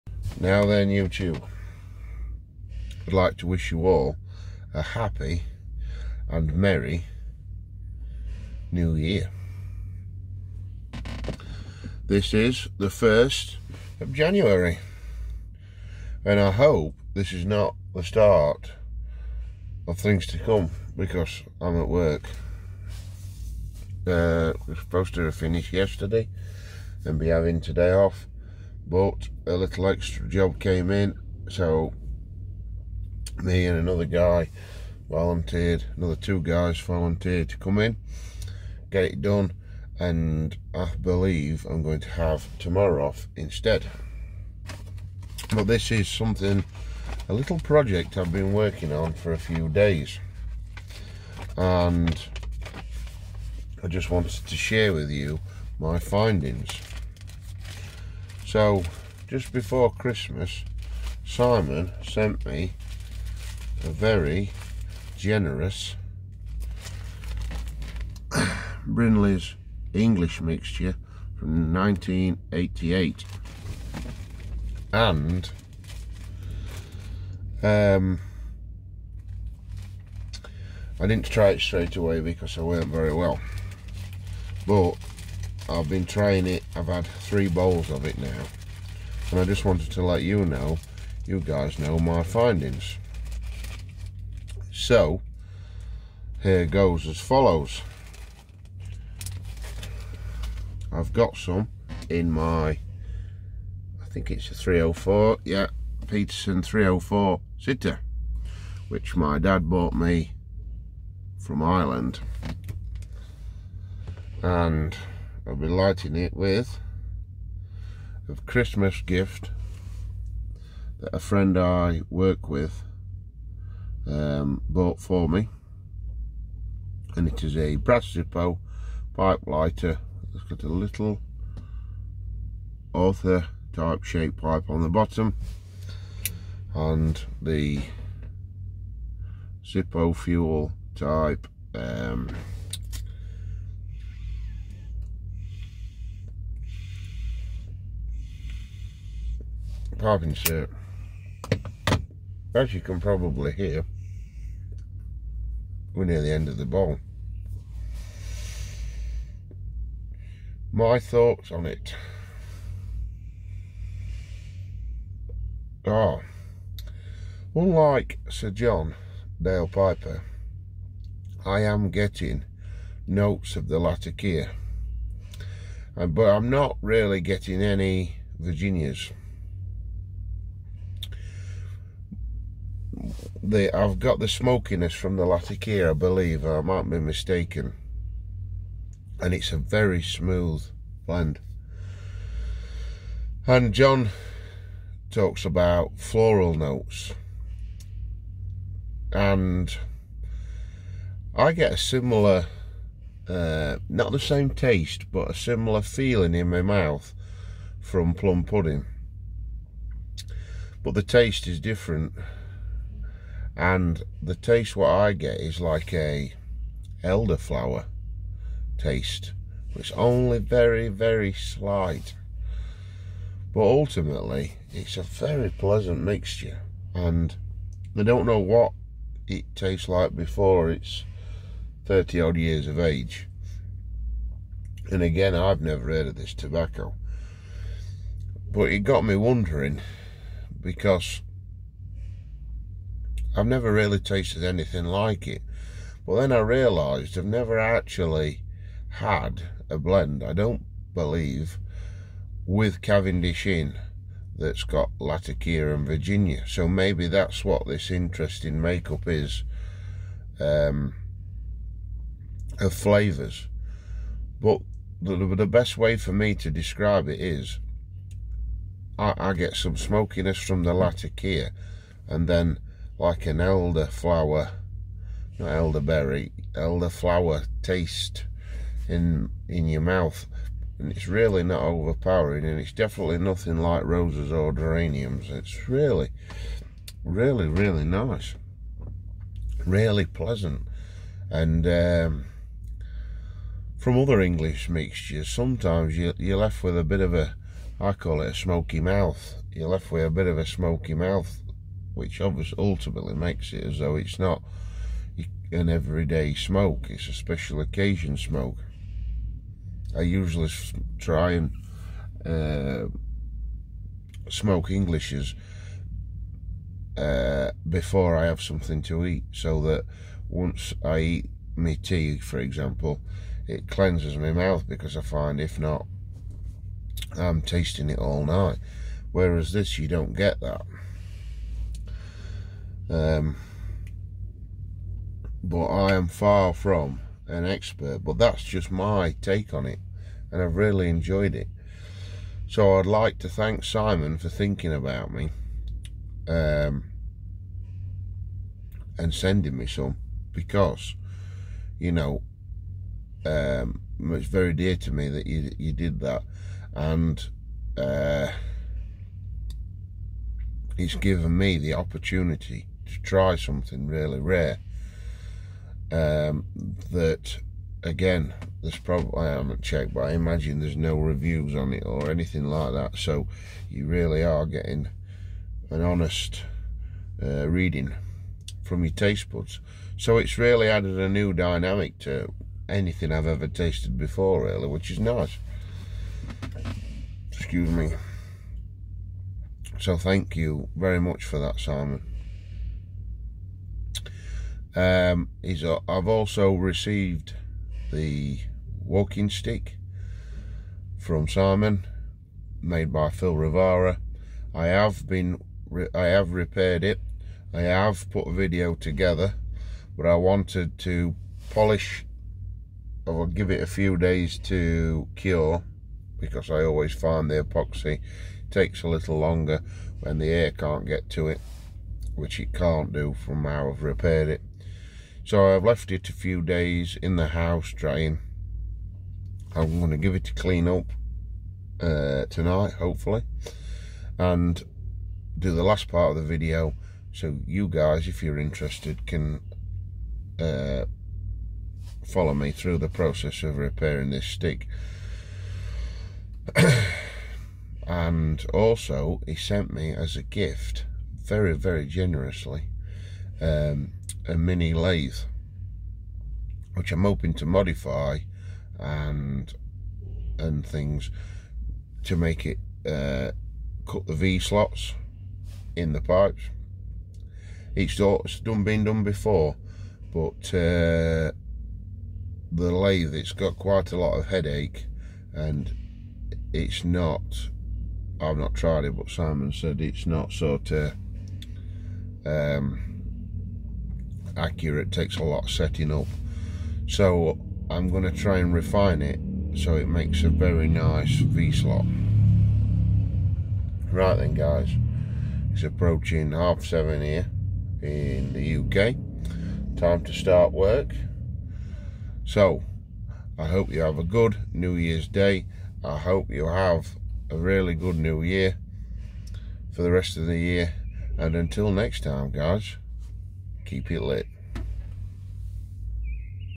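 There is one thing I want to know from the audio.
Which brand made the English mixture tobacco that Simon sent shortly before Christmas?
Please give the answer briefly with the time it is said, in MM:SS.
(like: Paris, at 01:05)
Brindley's, at 01:08.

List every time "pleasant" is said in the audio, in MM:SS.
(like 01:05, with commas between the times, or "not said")
03:45, 04:50.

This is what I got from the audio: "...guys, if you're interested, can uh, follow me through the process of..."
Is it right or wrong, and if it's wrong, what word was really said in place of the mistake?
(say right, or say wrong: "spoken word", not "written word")
right.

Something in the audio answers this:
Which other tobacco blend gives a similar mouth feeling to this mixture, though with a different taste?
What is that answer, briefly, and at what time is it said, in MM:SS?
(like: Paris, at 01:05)
Plum pudding, at 03:28.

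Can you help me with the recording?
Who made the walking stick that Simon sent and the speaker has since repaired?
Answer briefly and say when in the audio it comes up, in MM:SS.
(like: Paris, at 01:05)
Phil Rivara, at 06:43.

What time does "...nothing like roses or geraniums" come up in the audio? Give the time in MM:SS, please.
04:43.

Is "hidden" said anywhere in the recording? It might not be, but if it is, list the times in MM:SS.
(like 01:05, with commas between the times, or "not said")
not said.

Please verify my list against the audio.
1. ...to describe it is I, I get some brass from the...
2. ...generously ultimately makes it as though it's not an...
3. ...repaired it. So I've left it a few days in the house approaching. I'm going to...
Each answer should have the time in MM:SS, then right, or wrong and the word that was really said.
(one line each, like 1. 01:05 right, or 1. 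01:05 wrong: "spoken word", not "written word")
1. 04:26 wrong: "smokiness", not "brass"
2. 05:02 wrong: "obviously", not "generously"
3. 07:03 wrong: "drying", not "approaching".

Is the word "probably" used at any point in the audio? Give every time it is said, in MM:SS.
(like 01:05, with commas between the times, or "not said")
02:32, 06:08.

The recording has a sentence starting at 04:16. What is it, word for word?
So maybe that's what this interesting makeup is um, of flavours.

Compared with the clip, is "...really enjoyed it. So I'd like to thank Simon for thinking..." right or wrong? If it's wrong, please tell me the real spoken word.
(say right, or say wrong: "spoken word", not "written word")
right.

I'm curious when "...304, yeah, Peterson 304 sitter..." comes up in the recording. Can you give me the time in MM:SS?
01:44.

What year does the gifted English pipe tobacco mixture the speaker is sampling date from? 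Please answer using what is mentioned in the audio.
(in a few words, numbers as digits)
1988.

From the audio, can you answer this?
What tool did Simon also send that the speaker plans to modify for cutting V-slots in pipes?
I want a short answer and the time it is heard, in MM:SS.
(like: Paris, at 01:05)
A mini lathe, at 07:34.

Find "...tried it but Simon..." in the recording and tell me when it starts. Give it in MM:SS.
07:58.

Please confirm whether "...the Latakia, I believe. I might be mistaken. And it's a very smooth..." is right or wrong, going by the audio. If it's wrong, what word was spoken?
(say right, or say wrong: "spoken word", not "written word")
right.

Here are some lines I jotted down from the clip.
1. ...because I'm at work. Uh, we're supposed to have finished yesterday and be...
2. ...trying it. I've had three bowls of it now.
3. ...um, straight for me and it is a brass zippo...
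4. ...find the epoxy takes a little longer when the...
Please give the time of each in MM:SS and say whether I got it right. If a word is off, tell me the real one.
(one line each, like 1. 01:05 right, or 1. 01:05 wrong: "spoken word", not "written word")
1. 00:20 right
2. 01:26 right
3. 02:04 wrong: "bought", not "straight"
4. 06:56 right.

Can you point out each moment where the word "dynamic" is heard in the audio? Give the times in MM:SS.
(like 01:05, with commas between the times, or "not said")
06:21.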